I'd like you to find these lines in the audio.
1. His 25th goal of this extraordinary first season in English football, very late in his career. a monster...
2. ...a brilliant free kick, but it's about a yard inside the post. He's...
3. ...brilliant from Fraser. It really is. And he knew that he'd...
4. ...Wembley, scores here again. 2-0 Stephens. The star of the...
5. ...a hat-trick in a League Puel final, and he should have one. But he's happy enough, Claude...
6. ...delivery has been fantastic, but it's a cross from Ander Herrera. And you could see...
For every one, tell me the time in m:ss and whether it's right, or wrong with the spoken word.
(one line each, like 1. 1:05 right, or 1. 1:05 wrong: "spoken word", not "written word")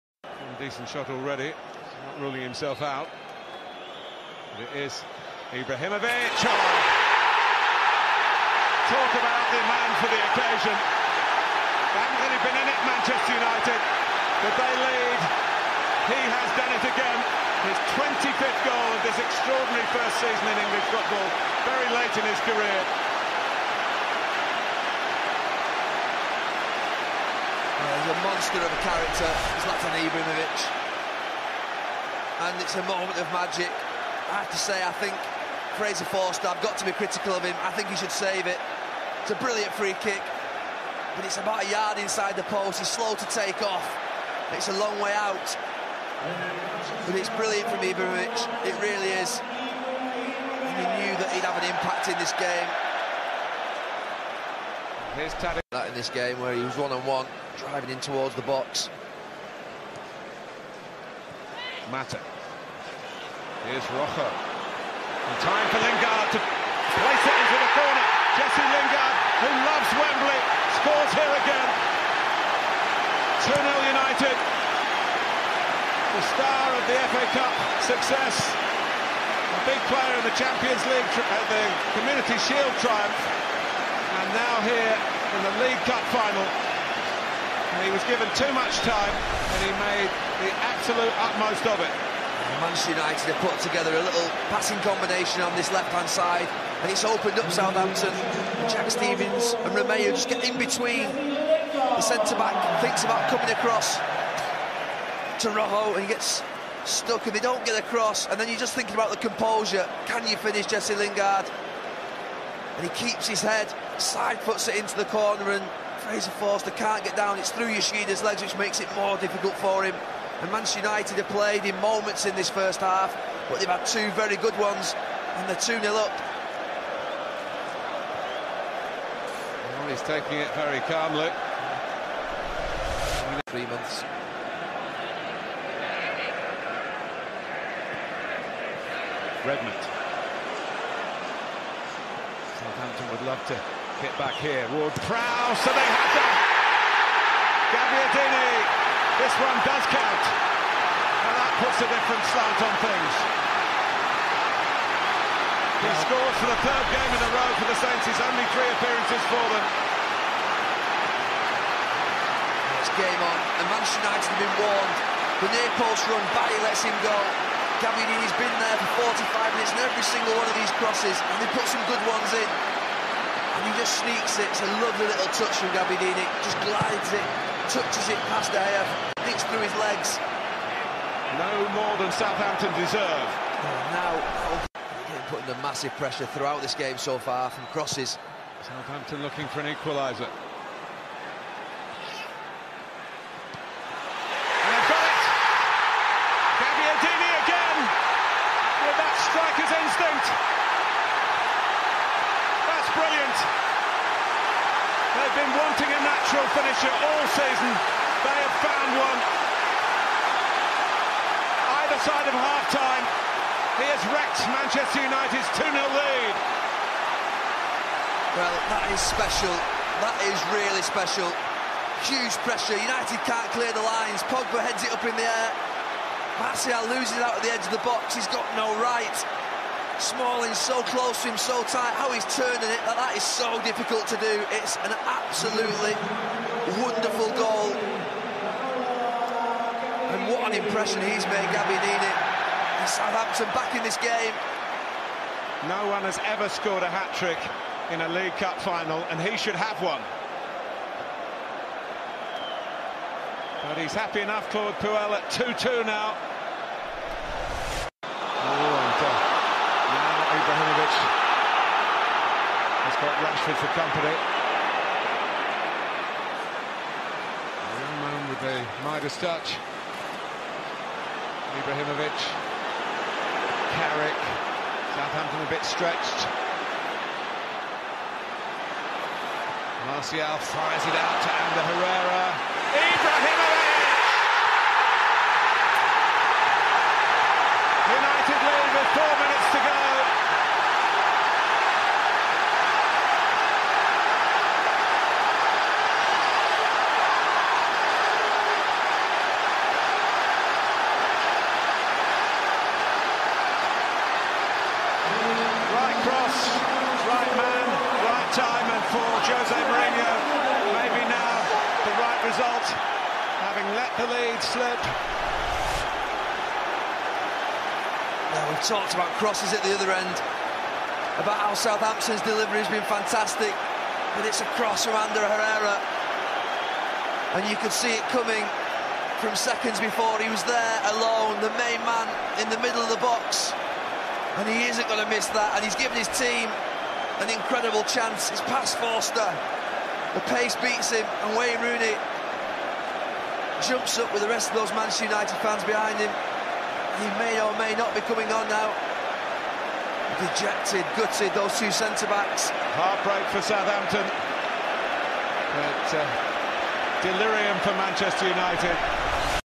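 1. 0:17 right
2. 0:39 right
3. 0:47 wrong: "Ibrahimovic", not "Fraser"
4. 1:09 wrong: "United", not "Stephens"
5. 4:06 wrong: "Cup", not "Puel"
6. 5:22 right.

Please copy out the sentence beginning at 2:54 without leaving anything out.
It's a lovely little touch from Gabbiadini.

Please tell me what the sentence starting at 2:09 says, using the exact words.
Well, he's taking it very calmly.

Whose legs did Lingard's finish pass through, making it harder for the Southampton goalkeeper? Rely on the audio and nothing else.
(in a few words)
Yoshida.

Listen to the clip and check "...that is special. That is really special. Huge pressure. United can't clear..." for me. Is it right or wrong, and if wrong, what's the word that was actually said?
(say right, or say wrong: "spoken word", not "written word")
right.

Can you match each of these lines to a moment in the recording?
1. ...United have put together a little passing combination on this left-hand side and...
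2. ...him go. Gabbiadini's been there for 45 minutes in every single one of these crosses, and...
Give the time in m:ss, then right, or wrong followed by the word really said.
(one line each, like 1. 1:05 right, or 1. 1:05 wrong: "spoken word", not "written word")
1. 1:32 right
2. 2:46 right.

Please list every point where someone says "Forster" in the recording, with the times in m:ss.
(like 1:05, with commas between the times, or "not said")
0:36, 1:56, 5:38.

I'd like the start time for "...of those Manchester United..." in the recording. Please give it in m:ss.
5:44.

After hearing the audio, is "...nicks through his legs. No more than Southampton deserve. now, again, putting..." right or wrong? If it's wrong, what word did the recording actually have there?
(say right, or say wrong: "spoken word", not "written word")
right.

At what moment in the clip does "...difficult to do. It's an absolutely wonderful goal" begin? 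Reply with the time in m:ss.
3:53.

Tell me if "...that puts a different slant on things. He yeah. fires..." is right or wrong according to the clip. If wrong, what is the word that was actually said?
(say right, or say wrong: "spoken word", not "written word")
wrong: "scores", not "fires".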